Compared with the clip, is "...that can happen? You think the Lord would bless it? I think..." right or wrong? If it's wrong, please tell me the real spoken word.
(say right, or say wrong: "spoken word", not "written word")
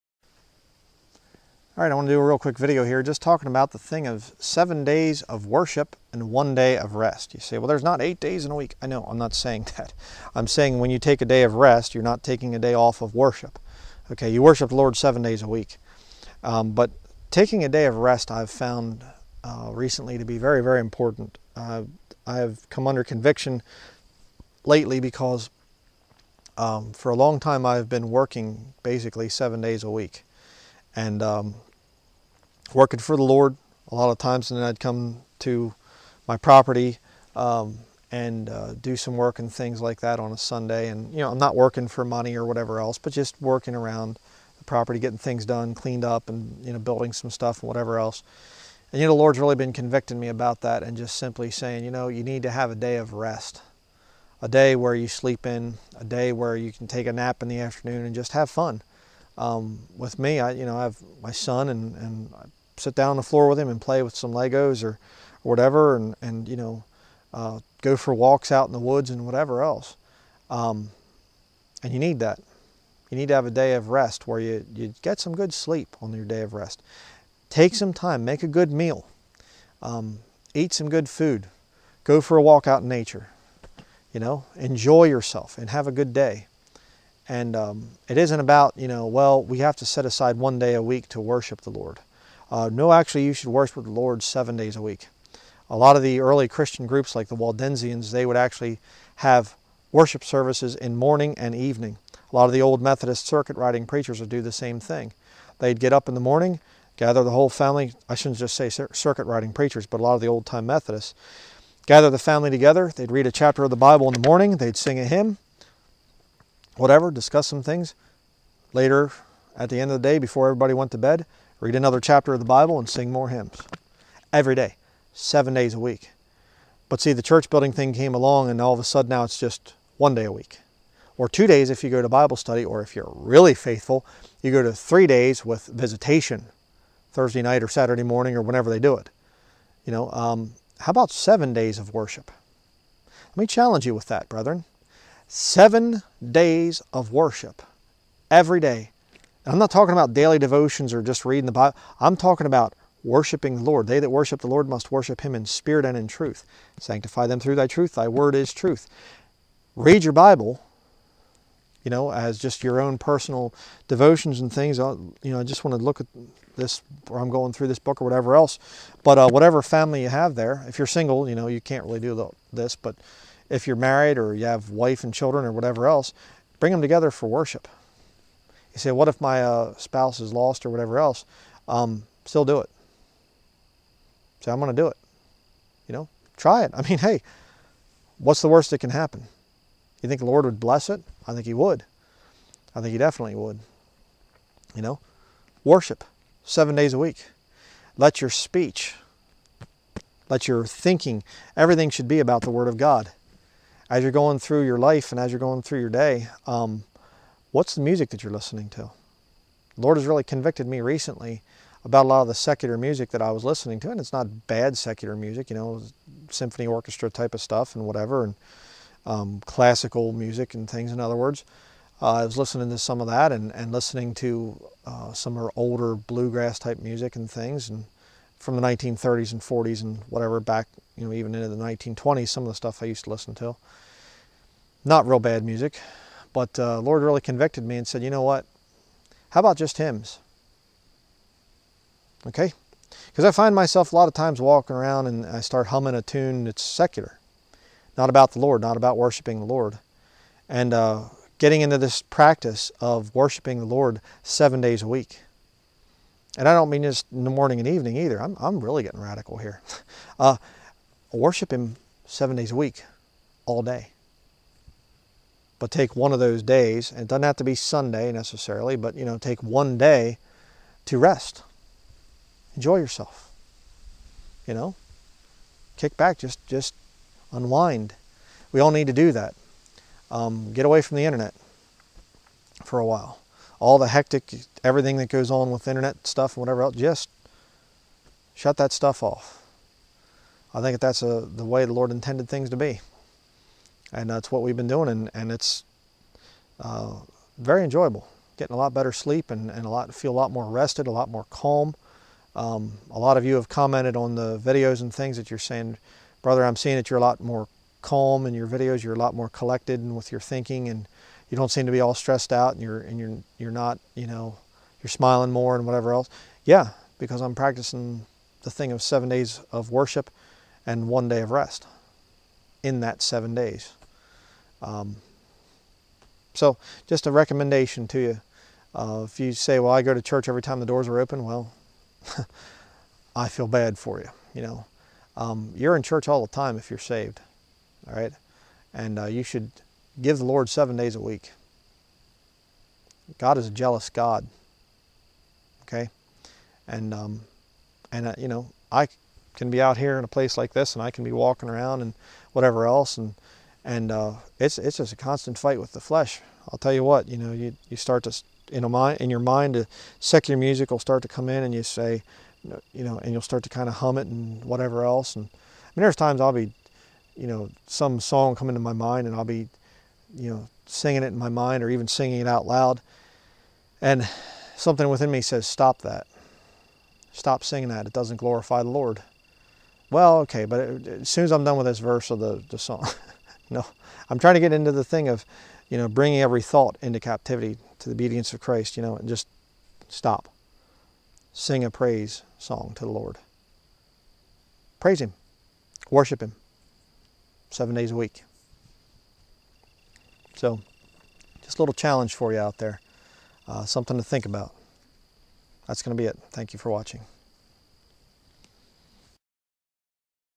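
right.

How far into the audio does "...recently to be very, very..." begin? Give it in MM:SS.
00:19.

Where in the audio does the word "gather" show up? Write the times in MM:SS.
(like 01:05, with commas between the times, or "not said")
01:46, 01:51.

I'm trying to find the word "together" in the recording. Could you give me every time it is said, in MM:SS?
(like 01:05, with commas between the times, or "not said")
01:52, 02:56.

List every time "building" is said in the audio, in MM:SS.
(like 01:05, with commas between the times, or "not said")
00:46, 02:07.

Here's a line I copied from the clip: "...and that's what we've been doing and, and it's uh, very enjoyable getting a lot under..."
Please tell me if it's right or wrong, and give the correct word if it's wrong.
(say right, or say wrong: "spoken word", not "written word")
wrong: "better", not "under".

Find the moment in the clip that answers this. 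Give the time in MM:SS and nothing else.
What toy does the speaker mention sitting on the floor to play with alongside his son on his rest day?
01:04.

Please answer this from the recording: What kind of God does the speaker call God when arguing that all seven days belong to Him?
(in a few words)
a jealous God.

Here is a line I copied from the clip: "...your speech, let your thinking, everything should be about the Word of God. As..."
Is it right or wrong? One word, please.
right.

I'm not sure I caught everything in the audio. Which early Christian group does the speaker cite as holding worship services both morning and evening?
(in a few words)
Waldensians.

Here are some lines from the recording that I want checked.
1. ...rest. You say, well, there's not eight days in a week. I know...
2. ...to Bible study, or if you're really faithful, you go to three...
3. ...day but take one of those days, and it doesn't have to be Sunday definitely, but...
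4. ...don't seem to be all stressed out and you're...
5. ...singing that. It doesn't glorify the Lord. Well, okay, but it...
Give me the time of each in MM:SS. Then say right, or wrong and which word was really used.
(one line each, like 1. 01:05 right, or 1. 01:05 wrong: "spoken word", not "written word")
1. 00:06 right
2. 02:12 right
3. 04:23 wrong: "necessarily", not "definitely"
4. 05:11 right
5. 06:17 right.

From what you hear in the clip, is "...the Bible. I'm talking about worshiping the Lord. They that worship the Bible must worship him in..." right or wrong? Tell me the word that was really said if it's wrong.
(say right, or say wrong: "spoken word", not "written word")
wrong: "Lord", not "Bible".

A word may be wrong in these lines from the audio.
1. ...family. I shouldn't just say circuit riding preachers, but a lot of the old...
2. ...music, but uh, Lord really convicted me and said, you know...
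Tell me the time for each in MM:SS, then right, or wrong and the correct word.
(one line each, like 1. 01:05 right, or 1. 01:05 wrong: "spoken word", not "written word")
1. 01:47 right
2. 03:55 right.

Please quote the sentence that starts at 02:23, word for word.
Let me challenge you with that, brethren.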